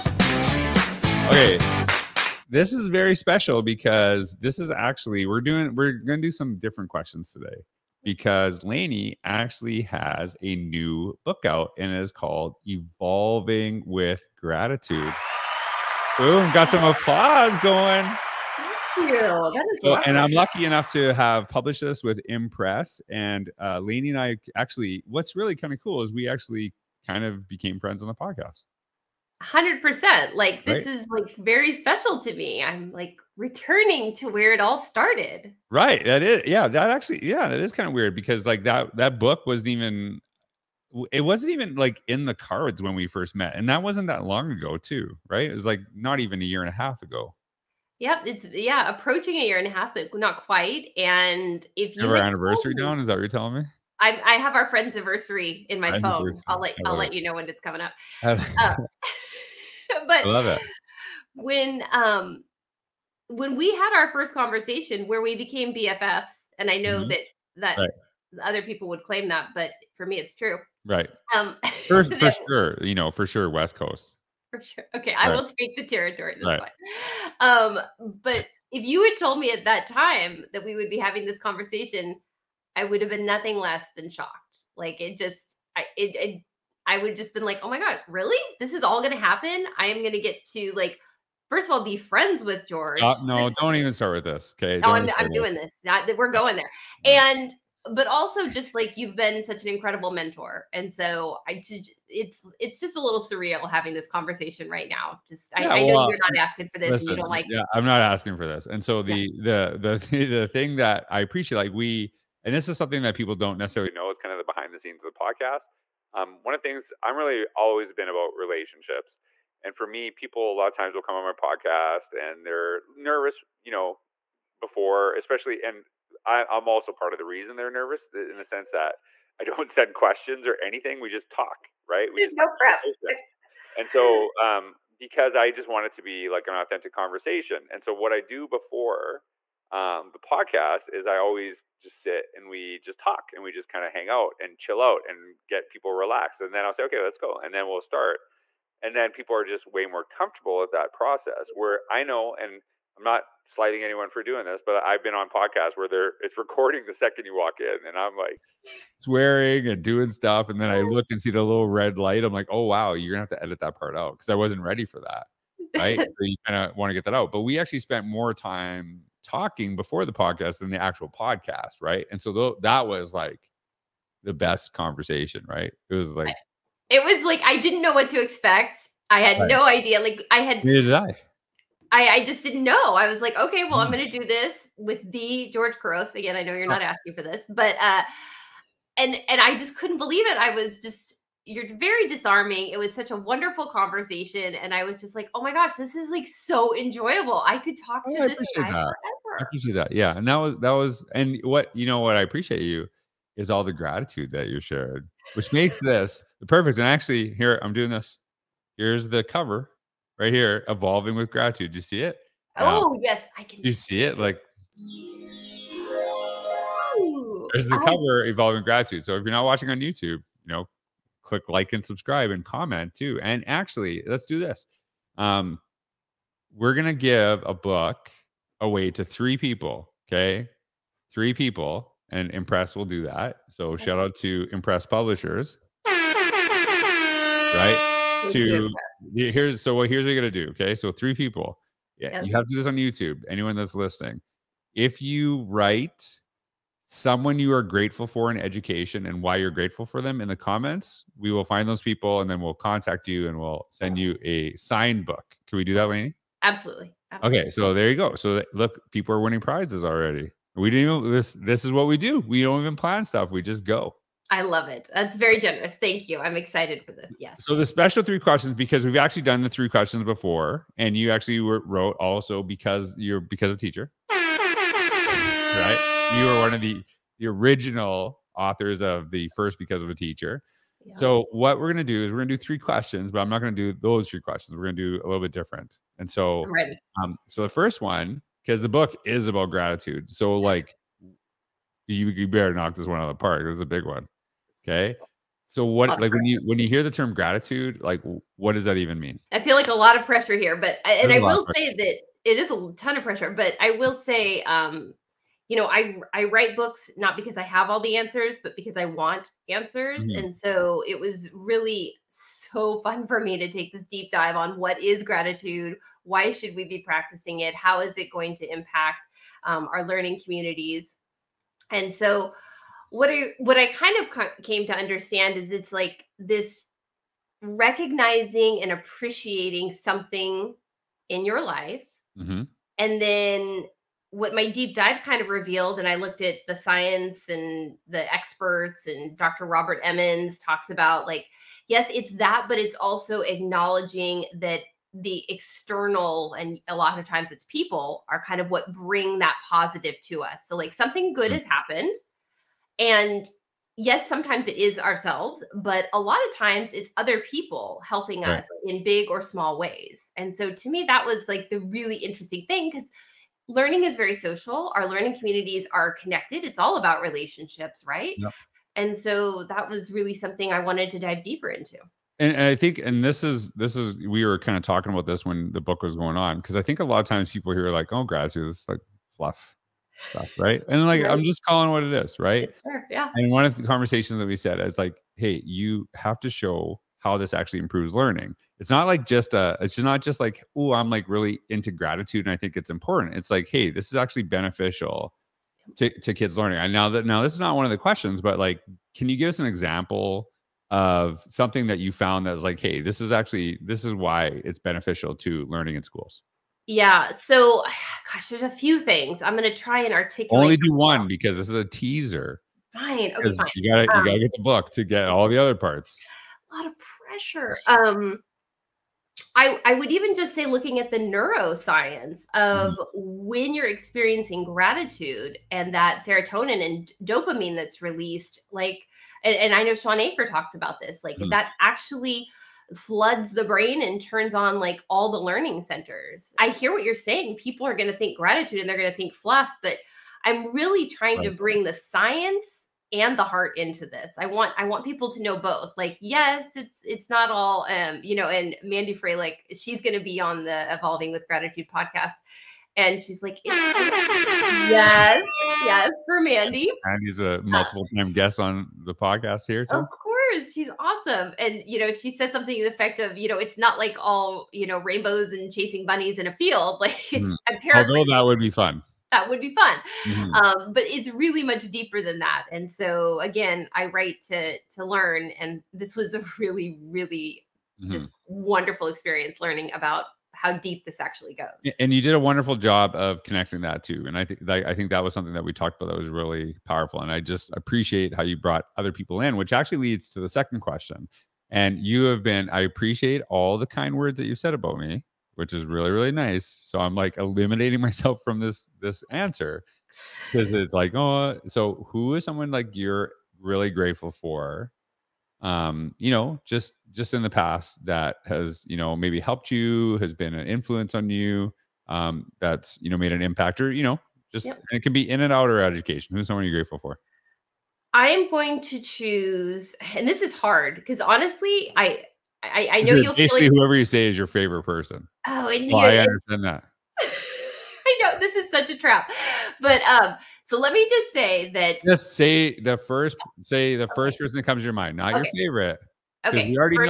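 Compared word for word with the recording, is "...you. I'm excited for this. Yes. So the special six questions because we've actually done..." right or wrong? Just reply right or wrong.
wrong.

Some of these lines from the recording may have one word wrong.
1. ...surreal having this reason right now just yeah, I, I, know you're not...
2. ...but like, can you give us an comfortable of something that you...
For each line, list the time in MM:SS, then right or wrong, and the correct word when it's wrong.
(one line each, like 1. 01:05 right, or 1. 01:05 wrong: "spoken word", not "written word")
1. 01:43 wrong: "conversation", not "reason"
2. 06:38 wrong: "example", not "comfortable".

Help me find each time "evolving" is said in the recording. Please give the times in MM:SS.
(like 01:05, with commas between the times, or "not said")
00:12, 03:30, 03:38, 07:30.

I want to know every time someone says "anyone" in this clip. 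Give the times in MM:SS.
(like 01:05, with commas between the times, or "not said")
02:33, 04:03.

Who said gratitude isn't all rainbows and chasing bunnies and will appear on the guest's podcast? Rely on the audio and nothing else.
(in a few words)
Mandy Froehlich.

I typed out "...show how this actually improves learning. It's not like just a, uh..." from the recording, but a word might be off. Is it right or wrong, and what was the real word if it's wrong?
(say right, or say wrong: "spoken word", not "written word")
right.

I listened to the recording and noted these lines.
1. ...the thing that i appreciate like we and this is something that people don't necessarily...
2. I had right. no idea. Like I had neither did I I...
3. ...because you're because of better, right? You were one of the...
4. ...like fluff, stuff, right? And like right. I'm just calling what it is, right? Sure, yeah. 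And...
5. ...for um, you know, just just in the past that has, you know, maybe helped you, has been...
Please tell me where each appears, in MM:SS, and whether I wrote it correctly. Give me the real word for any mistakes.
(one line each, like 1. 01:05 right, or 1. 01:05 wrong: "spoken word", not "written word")
1. 01:50 right
2. 02:59 right
3. 04:32 wrong: "teacher", not "better"
4. 06:18 right
5. 08:24 right.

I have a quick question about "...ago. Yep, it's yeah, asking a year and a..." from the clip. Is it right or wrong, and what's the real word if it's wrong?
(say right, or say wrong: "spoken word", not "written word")
wrong: "approaching", not "asking".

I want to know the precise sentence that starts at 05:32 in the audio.
and then what my deep dive kind of revealed, and I looked at the science and the experts, and Dr.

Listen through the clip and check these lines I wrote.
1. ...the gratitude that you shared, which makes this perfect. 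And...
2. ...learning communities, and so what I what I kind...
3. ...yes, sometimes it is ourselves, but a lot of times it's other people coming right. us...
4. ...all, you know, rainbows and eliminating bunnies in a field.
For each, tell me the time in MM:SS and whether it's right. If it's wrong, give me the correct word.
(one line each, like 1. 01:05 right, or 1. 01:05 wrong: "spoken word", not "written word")
1. 03:23 right
2. 05:19 right
3. 05:53 wrong: "helping", not "coming"
4. 07:43 wrong: "chasing", not "eliminating".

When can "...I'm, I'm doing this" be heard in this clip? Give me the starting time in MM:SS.
01:34.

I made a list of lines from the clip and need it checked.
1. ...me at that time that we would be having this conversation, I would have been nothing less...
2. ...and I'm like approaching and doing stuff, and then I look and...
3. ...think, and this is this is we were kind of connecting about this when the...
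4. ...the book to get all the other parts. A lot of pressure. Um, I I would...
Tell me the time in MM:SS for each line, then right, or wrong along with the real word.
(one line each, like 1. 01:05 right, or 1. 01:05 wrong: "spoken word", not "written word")
1. 01:19 right
2. 02:37 wrong: "swearing", not "approaching"
3. 06:12 wrong: "talking", not "connecting"
4. 06:54 right.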